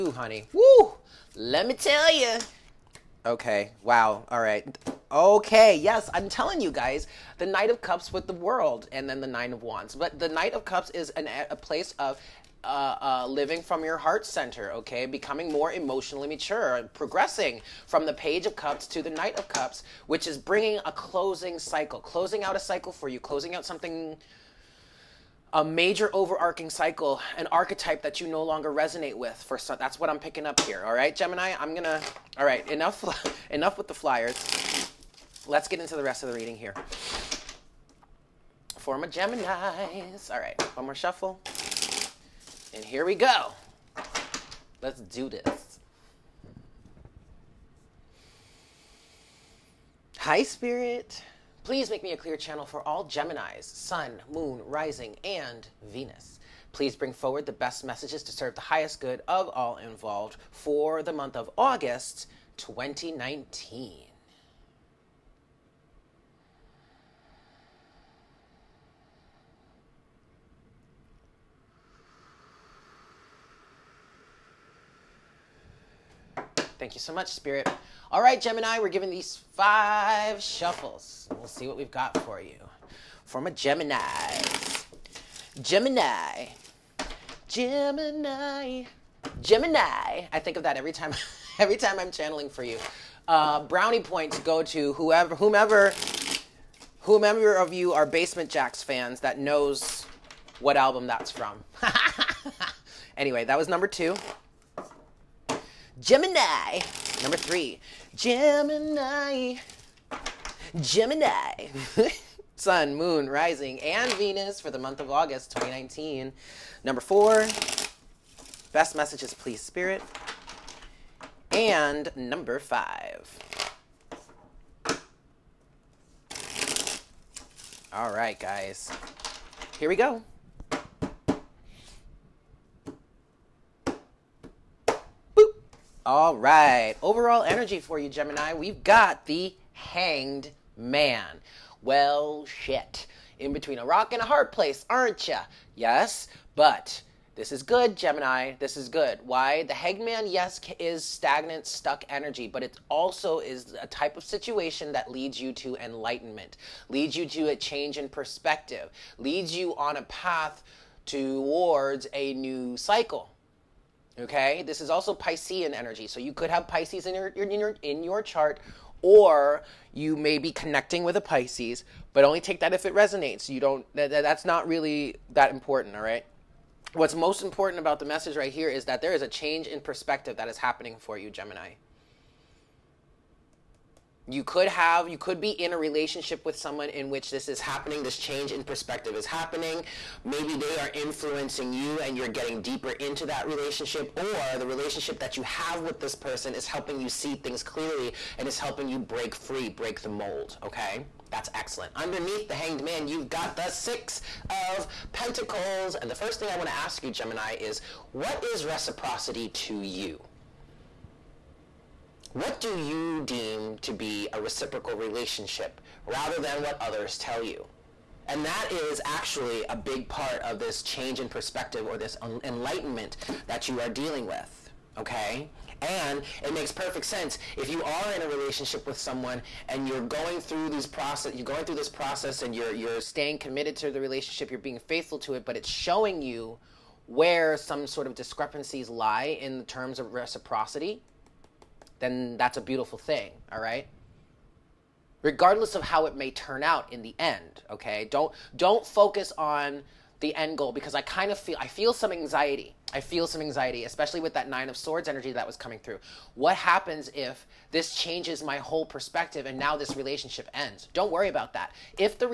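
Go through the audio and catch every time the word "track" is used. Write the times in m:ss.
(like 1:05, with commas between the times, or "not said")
not said.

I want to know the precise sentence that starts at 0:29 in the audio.
For so, that's what I'm picking up here.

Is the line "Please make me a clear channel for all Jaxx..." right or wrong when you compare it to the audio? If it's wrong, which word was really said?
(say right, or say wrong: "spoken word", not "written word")
wrong: "Geminis", not "Jaxx".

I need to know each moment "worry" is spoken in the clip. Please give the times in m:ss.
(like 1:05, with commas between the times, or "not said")
4:21.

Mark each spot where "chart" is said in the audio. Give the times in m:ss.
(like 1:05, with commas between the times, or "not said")
2:48.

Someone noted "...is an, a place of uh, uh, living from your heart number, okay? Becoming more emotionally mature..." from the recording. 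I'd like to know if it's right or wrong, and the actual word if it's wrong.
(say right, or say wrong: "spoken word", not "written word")
wrong: "center", not "number".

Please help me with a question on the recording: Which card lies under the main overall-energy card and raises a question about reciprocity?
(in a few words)
Six of Pentacles.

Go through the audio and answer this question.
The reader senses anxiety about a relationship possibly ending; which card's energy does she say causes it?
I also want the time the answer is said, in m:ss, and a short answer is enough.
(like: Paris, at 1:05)
9 of Swords, at 4:14.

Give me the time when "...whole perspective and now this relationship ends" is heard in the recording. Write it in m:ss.
4:18.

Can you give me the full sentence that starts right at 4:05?
Regardless of how it may turn out in the end, okay?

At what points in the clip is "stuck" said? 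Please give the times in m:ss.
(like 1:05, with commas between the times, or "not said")
2:31.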